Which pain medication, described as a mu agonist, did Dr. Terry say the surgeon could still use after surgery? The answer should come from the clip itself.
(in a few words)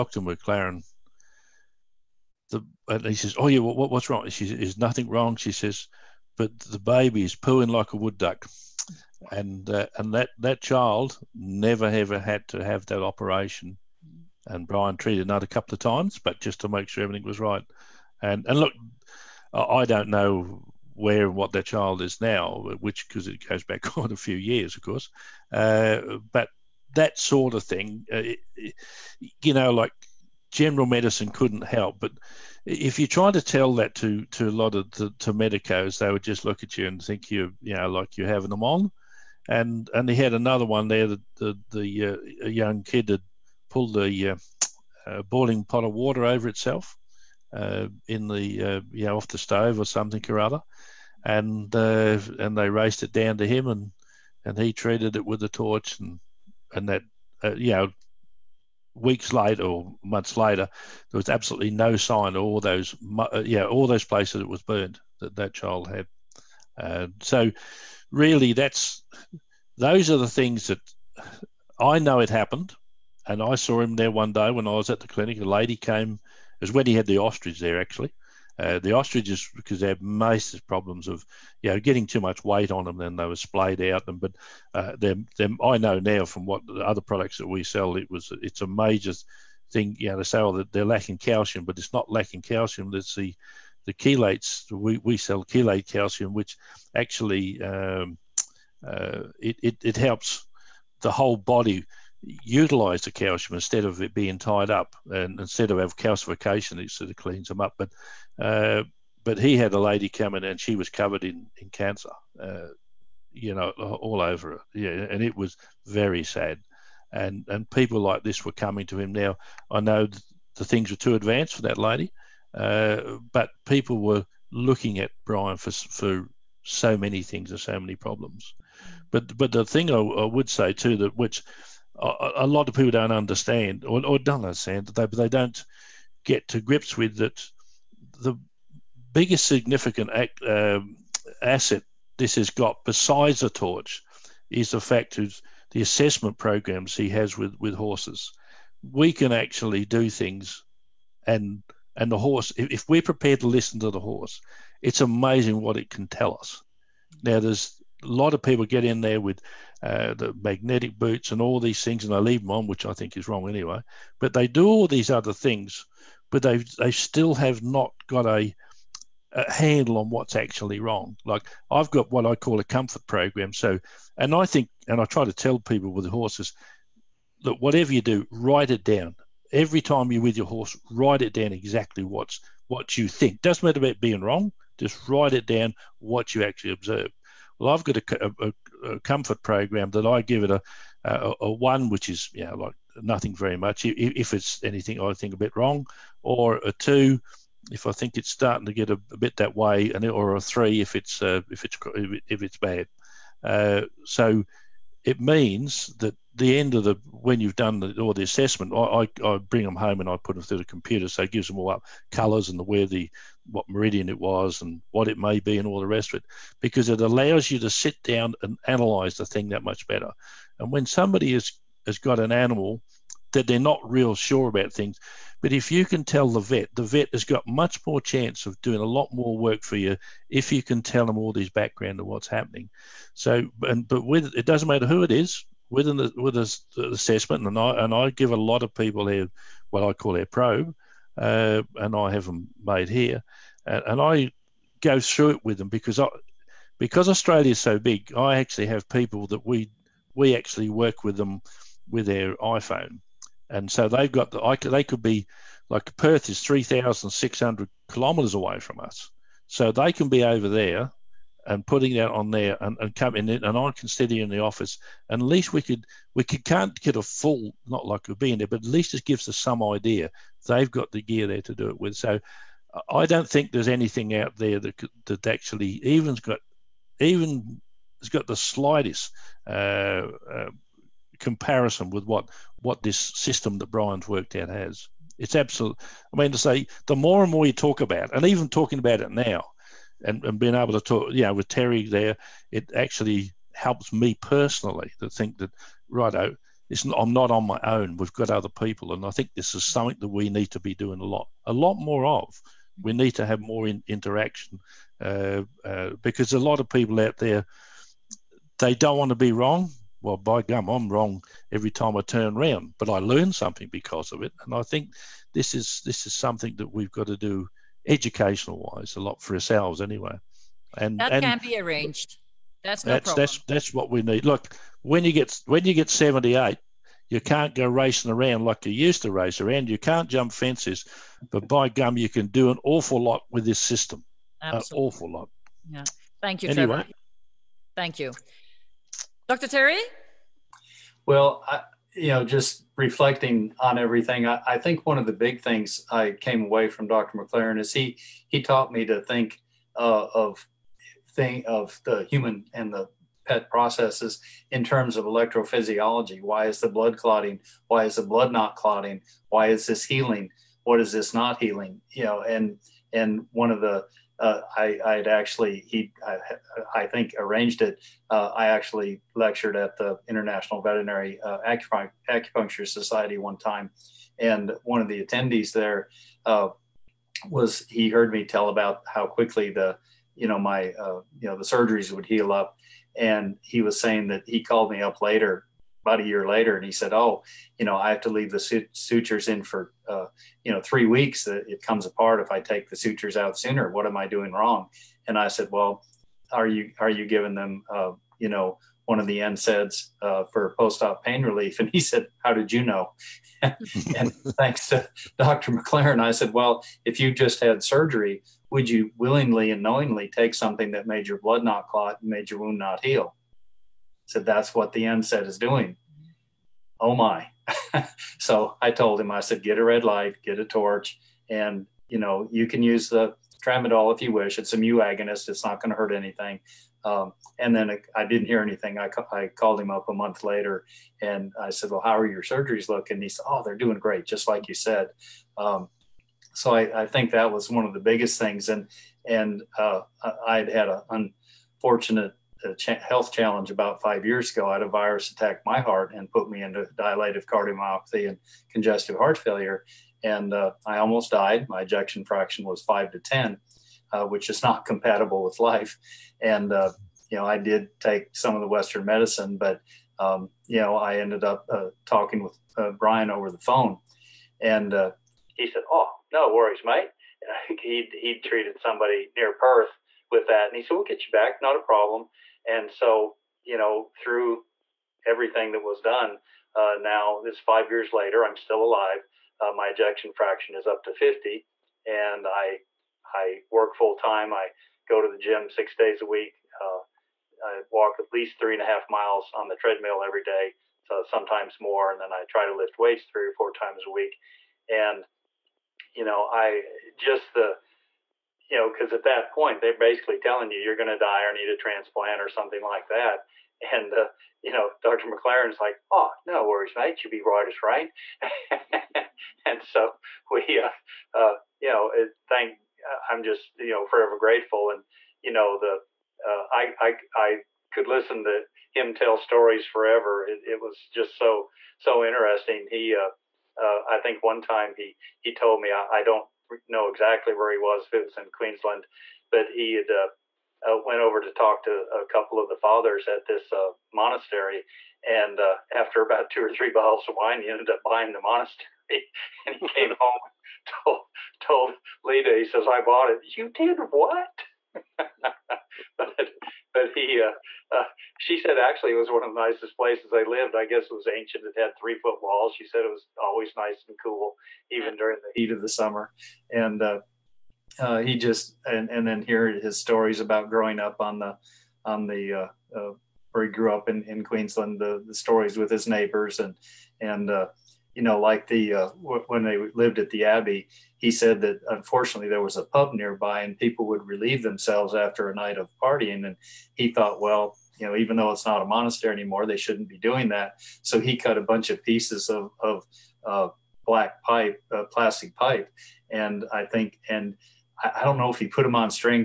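tramadol.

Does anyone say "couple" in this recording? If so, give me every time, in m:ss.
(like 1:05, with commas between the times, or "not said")
0:15, 8:52.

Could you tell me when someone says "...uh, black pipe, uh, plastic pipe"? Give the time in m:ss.
9:43.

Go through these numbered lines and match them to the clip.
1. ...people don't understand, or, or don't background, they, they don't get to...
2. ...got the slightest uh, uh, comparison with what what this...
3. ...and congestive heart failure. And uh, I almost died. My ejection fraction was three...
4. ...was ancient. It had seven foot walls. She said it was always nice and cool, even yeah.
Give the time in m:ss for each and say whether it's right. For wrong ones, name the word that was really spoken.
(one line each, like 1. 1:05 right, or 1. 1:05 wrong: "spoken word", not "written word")
1. 2:12 wrong: "understand", not "background"
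2. 4:38 right
3. 7:28 wrong: "five", not "three"
4. 9:10 wrong: "three", not "seven".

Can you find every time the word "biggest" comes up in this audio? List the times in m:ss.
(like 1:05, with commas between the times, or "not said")
2:19, 7:17.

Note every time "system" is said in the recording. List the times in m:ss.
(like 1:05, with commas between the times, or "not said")
4:43, 5:33.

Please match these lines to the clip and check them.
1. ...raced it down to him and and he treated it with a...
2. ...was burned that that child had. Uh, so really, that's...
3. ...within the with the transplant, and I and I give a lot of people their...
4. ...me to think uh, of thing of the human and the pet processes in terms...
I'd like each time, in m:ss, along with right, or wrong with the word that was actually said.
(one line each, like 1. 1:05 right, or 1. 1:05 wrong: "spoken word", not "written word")
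1. 0:52 right
2. 1:04 right
3. 3:55 wrong: "assessment", not "transplant"
4. 5:48 right.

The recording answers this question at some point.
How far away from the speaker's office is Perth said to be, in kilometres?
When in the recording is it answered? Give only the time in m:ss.
4:16.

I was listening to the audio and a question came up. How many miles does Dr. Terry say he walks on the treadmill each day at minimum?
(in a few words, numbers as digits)
3.5 miles.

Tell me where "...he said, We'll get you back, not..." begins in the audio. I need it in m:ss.
7:50.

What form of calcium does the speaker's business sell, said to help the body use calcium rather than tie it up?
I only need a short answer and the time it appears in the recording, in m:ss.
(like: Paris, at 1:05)
chelate calcium, at 1:35.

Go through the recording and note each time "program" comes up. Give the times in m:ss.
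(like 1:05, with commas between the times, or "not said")
2:26, 2:53, 3:09.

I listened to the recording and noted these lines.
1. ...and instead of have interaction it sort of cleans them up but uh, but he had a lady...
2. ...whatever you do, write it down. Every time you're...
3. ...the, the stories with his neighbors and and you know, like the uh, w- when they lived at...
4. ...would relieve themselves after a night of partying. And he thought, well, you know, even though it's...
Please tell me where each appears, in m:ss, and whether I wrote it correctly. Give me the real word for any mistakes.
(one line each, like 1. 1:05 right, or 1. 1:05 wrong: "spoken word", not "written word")
1. 1:45 wrong: "calcification", not "interaction"
2. 2:57 right
3. 9:24 right
4. 9:33 right.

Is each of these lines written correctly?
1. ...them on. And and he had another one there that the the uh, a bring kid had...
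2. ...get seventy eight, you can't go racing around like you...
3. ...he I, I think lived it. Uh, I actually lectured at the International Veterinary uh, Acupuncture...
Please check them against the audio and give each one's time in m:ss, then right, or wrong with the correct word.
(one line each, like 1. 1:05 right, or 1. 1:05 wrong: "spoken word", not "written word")
1. 0:38 wrong: "young", not "bring"
2. 5:25 right
3. 6:05 wrong: "arranged", not "lived".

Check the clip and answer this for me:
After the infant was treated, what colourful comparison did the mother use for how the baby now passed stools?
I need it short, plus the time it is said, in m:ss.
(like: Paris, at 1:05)
like a wood duck, at 0:07.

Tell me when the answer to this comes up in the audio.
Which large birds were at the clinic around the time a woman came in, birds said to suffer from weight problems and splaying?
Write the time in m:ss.
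1:18.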